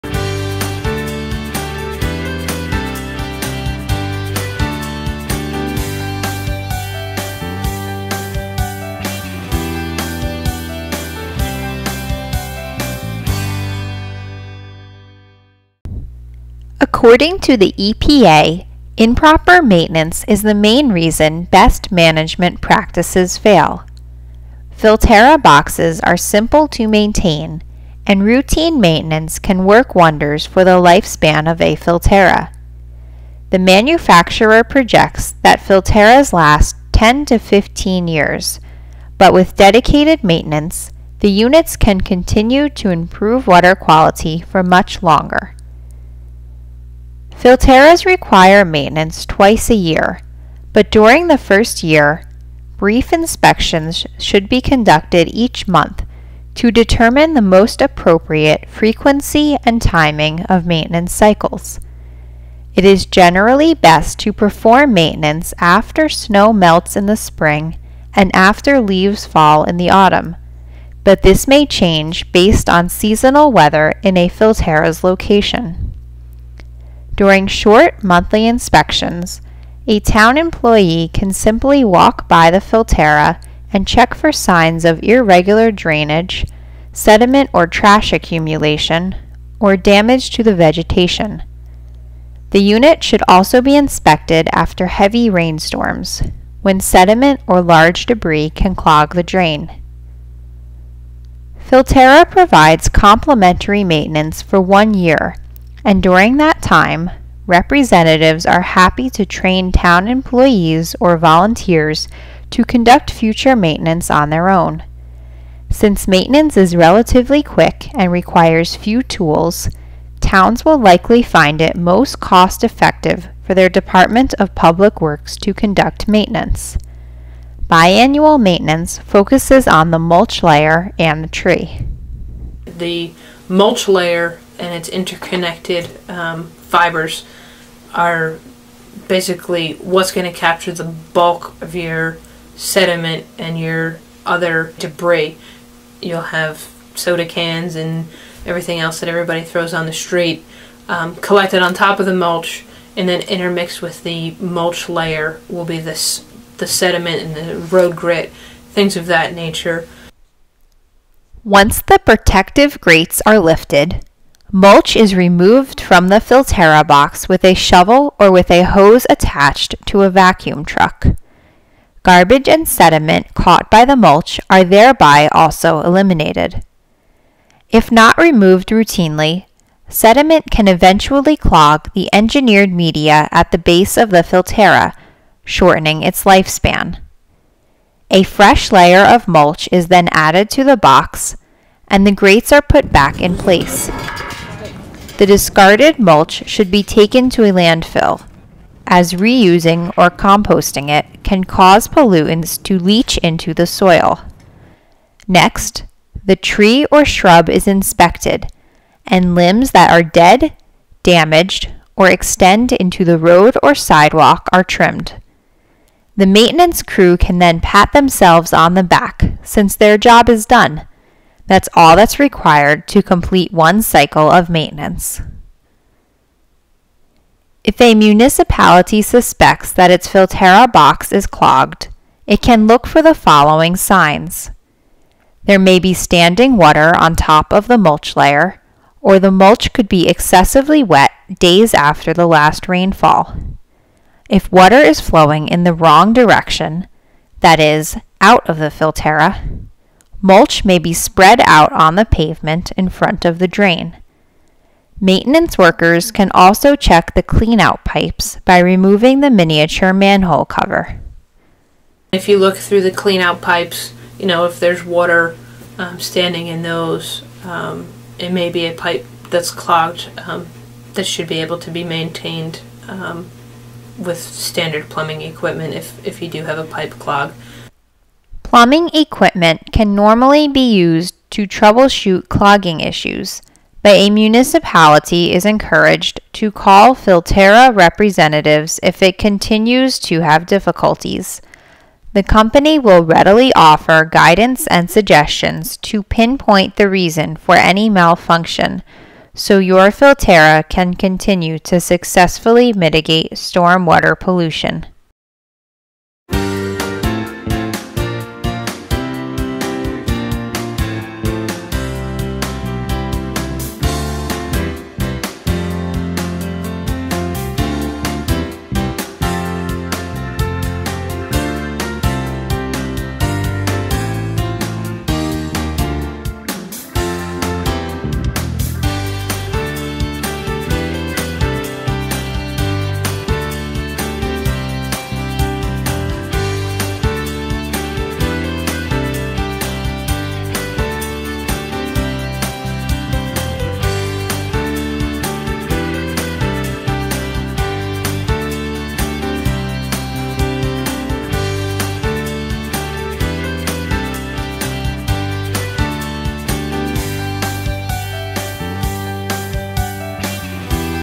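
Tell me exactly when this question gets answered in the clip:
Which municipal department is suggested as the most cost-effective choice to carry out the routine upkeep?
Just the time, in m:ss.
2:03.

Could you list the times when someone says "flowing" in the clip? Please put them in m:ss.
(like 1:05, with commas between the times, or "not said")
4:05.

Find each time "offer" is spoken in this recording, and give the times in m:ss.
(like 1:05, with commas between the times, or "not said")
4:53.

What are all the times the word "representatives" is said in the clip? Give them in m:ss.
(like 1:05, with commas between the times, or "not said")
1:47, 4:47.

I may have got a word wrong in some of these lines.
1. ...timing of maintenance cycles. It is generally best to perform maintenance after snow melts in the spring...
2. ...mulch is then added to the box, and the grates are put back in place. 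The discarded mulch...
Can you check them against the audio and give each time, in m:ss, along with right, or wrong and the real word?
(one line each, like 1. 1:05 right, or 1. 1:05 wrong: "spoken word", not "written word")
1. 0:59 right
2. 3:09 right.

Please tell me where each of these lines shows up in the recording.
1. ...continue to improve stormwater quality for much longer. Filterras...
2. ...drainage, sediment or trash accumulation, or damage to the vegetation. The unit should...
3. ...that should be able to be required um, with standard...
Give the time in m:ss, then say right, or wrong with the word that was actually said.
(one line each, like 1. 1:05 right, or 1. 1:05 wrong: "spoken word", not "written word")
1. 0:42 wrong: "water", not "stormwater"
2. 1:25 right
3. 4:30 wrong: "maintained", not "required".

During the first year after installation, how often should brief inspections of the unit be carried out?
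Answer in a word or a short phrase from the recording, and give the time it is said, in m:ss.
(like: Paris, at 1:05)
Each month, at 0:55.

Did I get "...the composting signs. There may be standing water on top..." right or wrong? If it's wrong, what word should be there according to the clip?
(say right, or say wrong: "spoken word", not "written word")
wrong: "following", not "composting".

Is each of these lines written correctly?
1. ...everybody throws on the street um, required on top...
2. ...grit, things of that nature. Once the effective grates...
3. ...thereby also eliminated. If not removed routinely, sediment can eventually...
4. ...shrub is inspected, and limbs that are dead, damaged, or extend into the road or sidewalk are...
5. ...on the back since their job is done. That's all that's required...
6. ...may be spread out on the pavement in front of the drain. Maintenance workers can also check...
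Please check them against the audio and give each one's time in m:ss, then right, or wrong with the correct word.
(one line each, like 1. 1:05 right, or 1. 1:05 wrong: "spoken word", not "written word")
1. 2:29 wrong: "collected", not "required"
2. 2:37 wrong: "protective", not "effective"
3. 2:54 right
4. 3:27 right
5. 3:38 right
6. 4:10 right.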